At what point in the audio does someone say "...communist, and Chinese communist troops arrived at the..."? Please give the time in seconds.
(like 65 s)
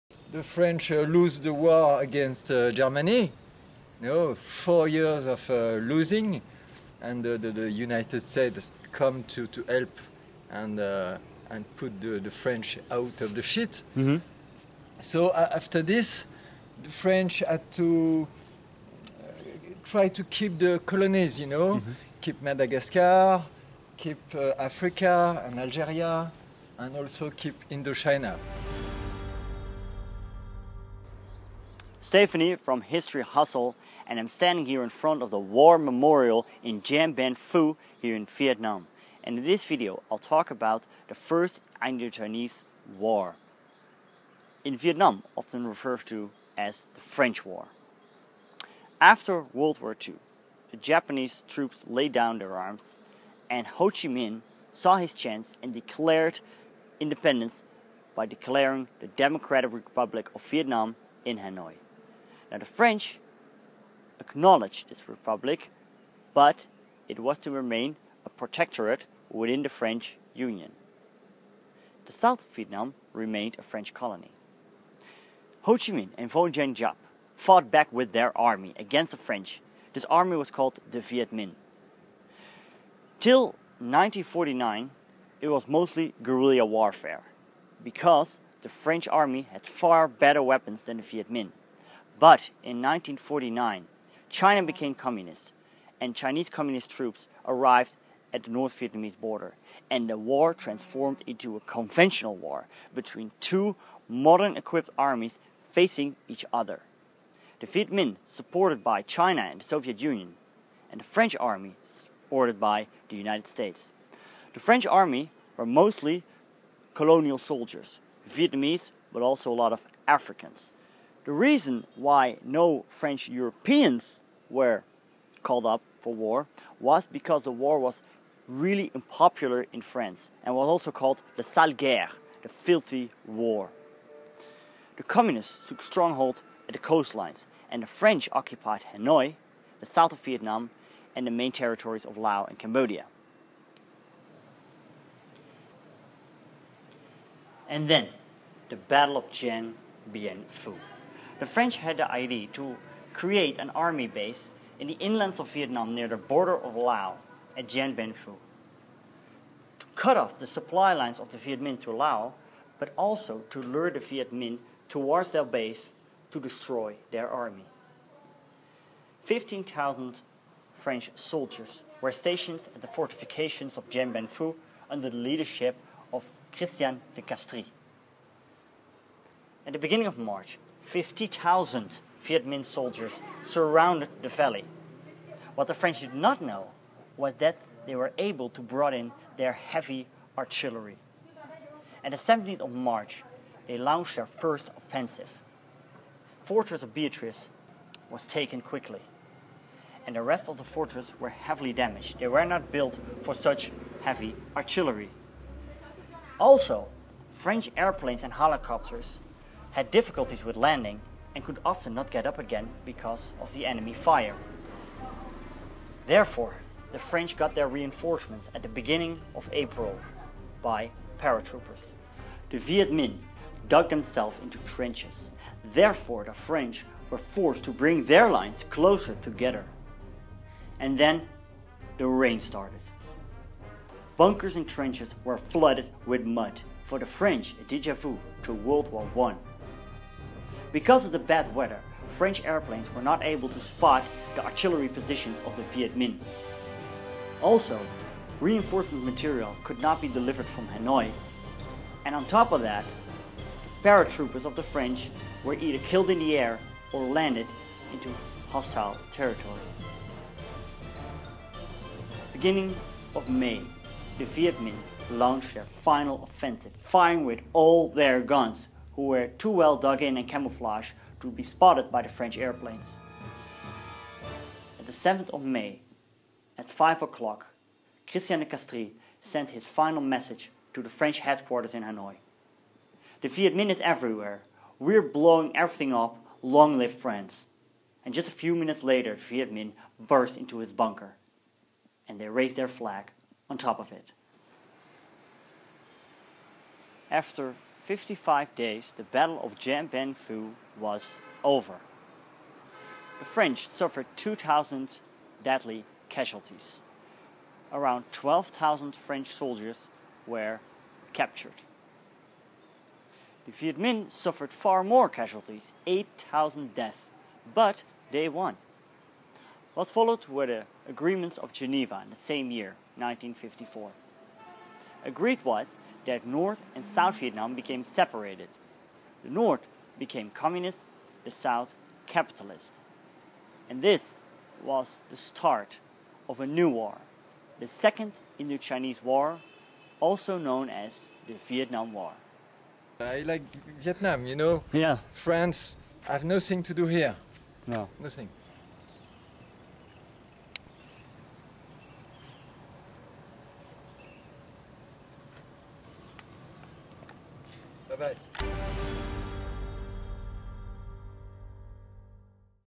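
94 s.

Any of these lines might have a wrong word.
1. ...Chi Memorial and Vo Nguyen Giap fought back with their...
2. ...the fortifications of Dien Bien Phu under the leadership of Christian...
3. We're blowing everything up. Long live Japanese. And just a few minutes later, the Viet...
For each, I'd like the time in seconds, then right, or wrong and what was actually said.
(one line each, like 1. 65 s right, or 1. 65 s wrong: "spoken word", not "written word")
1. 75 s wrong: "Minh", not "Memorial"
2. 172 s right
3. 284 s wrong: "France", not "Japanese".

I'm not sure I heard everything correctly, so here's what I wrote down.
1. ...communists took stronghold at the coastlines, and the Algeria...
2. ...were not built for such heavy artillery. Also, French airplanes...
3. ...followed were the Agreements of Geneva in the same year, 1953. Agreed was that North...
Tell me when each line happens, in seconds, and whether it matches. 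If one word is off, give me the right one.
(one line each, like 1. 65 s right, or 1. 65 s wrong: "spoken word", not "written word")
1. 135 s wrong: "French", not "Algeria"
2. 202 s right
3. 319 s wrong: "1954", not "1953".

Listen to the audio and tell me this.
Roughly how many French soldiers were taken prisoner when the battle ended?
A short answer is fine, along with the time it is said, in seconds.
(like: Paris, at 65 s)
12,000, at 307 s.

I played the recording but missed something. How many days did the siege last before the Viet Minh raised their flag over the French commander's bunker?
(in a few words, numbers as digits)
55.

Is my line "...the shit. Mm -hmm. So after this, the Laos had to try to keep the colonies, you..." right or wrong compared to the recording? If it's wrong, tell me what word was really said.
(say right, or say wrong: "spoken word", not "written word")
wrong: "French", not "Laos".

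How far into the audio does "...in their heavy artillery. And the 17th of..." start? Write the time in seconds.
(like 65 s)
188 s.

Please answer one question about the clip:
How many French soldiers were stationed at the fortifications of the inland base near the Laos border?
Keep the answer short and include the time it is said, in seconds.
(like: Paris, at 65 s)
15,000, at 169 s.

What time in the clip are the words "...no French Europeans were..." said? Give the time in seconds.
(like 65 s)
122 s.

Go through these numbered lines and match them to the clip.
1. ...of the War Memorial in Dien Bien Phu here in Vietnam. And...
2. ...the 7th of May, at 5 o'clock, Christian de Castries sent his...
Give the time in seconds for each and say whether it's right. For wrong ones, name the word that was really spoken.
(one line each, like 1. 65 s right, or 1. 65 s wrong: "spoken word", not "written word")
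1. 35 s right
2. 274 s right.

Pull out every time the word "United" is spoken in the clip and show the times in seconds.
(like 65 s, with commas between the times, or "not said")
7 s, 113 s.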